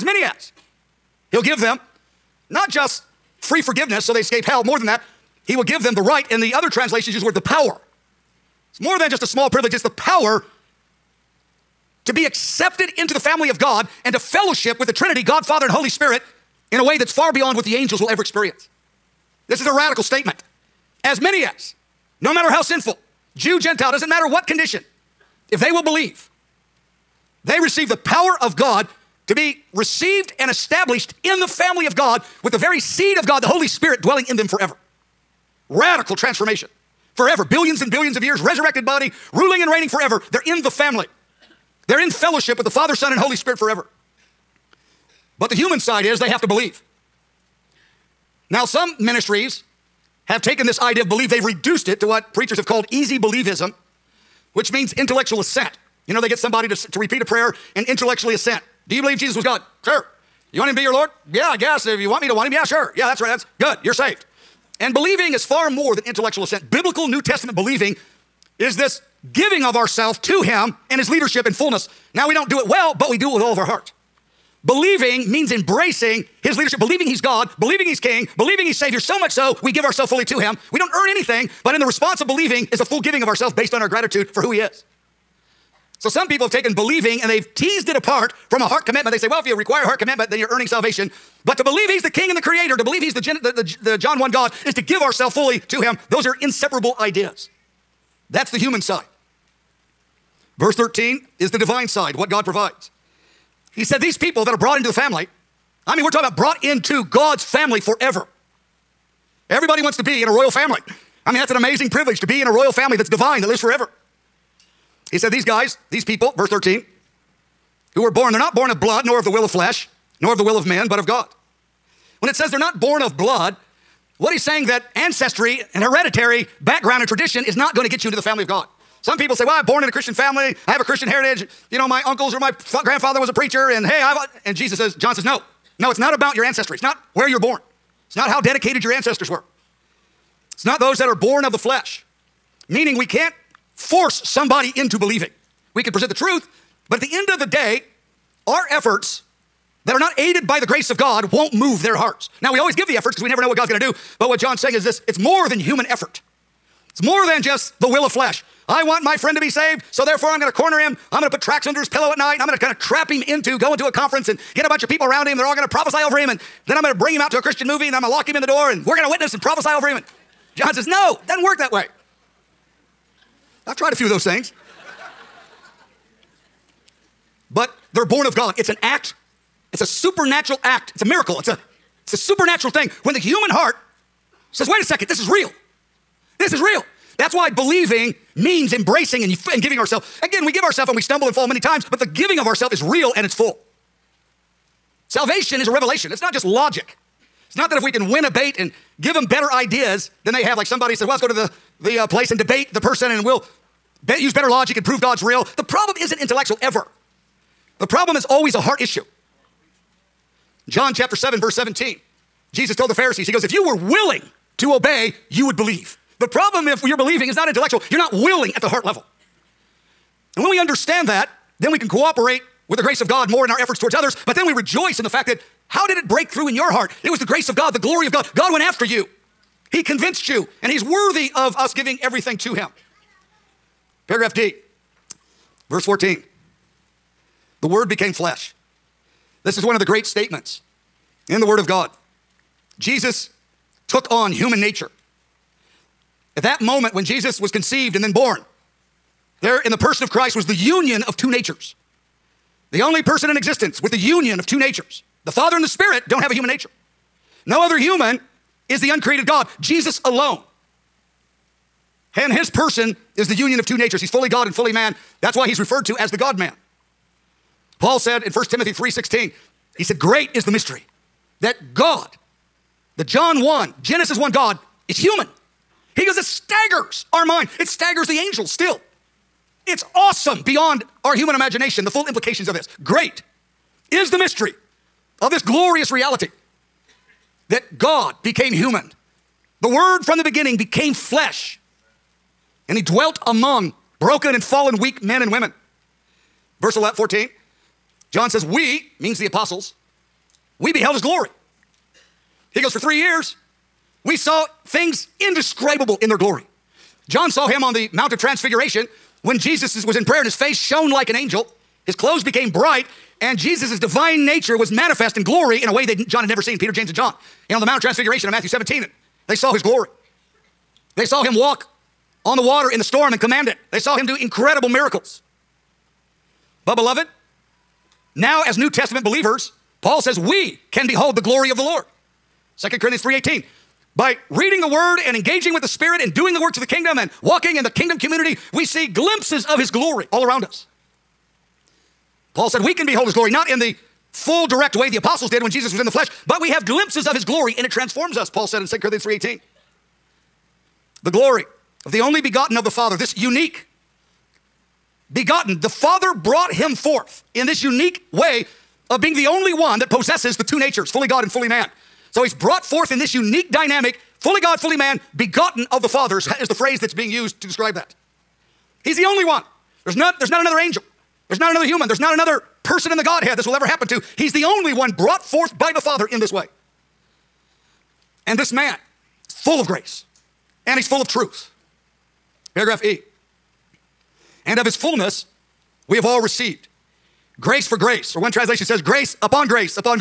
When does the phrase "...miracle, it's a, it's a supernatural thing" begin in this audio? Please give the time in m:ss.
3:01.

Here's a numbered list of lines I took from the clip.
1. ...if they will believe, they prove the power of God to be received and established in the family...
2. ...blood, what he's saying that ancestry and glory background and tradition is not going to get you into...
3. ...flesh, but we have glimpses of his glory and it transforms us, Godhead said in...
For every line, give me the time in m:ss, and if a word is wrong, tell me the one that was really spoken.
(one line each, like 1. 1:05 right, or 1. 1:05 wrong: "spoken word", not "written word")
1. 0:25 wrong: "receive", not "prove"
2. 2:03 wrong: "hereditary", not "glory"
3. 5:45 wrong: "Paul", not "Godhead".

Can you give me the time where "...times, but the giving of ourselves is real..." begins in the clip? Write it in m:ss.
3:11.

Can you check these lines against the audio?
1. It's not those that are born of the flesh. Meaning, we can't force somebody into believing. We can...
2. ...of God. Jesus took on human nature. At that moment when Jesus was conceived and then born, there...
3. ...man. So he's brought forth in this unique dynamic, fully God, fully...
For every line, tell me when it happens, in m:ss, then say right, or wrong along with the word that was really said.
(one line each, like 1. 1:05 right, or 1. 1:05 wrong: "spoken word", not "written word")
1. 2:20 right
2. 4:01 right
3. 6:01 right.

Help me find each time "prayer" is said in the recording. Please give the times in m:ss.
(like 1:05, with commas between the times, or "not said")
0:57, 5:10.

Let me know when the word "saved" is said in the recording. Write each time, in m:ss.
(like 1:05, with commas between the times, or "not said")
1:03, 2:39.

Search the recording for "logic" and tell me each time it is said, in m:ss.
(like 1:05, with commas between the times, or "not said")
3:16, 3:24.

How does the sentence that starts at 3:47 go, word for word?
It was the grace of God, the glory of God.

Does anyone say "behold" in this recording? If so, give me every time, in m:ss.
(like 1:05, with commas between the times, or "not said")
5:30, 5:42.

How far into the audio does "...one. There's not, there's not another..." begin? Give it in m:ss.
6:09.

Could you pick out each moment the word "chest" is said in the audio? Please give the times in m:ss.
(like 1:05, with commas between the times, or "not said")
not said.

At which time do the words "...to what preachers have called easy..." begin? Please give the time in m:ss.
0:51.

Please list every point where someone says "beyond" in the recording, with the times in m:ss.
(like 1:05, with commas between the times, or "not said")
0:17, 4:40.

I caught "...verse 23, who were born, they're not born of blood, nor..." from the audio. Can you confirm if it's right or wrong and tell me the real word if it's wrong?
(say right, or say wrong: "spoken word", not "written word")
wrong: "13", not "23".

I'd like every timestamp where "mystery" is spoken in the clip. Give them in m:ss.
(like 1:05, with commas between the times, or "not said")
4:30, 4:44.